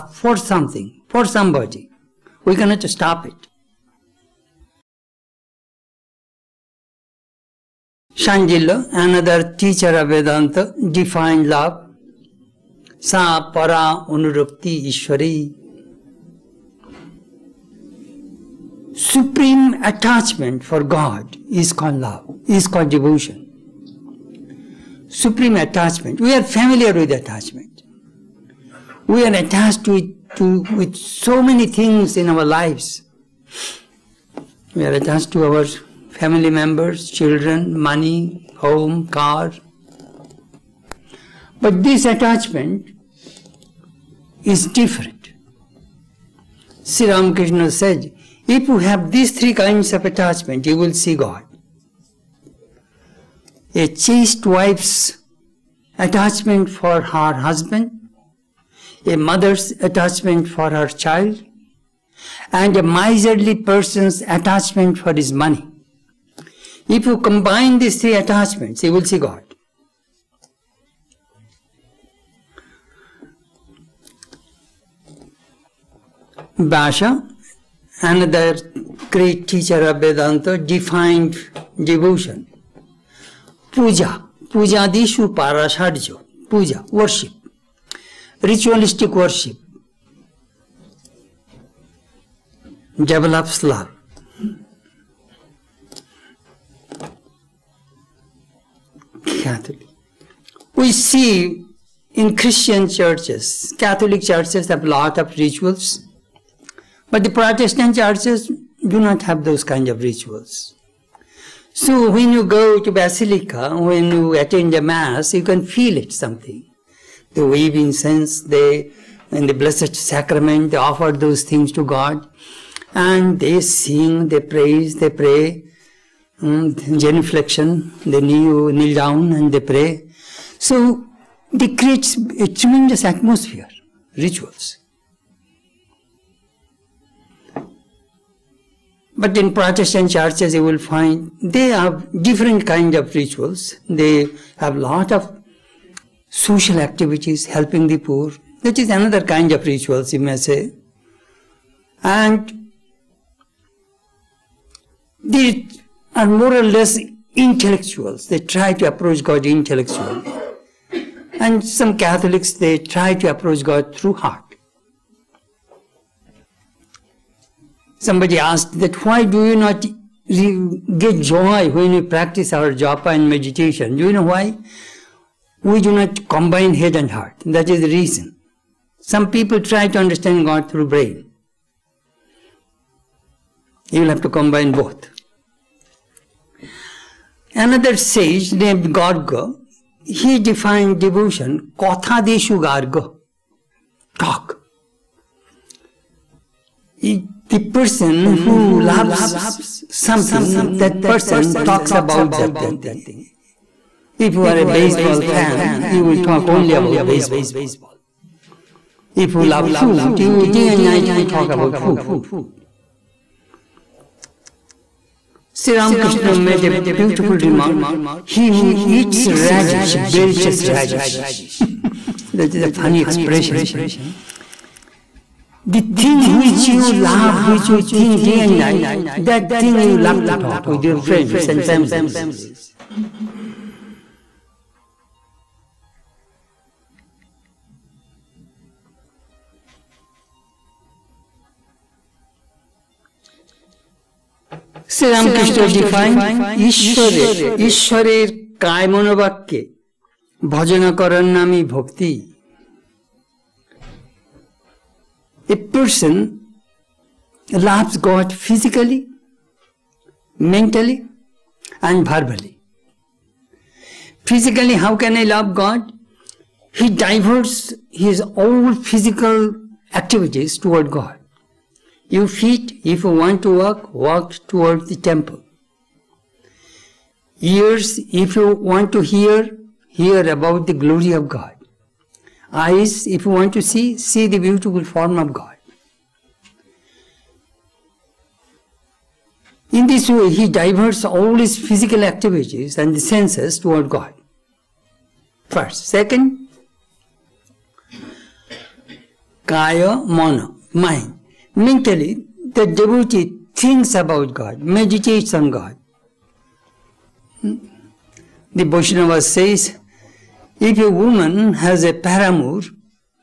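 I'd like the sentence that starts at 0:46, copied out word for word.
Sri Ramakrishna said, if you have these three kinds of attachment, you will see God.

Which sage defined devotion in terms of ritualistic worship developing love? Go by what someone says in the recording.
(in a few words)
Vyasa.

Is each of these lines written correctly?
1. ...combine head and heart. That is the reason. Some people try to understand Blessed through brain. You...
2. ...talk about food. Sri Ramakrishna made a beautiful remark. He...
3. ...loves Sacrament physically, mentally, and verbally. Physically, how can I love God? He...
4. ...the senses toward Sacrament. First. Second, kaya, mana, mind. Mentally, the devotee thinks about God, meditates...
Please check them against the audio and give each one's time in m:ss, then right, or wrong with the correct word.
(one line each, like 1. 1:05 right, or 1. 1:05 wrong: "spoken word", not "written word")
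1. 2:56 wrong: "God", not "Blessed"
2. 3:31 right
3. 4:17 wrong: "God", not "Sacrament"
4. 4:52 wrong: "God", not "Sacrament".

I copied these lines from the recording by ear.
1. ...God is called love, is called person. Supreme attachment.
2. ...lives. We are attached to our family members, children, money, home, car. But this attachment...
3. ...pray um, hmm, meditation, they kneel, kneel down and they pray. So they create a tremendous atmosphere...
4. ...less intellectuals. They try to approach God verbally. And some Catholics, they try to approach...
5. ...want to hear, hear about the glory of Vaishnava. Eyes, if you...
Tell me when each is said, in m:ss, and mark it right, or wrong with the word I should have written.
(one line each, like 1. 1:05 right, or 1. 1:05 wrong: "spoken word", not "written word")
1. 0:20 wrong: "devotion", not "person"
2. 0:32 right
3. 2:05 wrong: "genuflection", not "meditation"
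4. 2:36 wrong: "intellectually", not "verbally"
5. 4:38 wrong: "God", not "Vaishnava".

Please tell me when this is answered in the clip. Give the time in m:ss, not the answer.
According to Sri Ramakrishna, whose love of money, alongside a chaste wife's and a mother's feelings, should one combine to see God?
1:02.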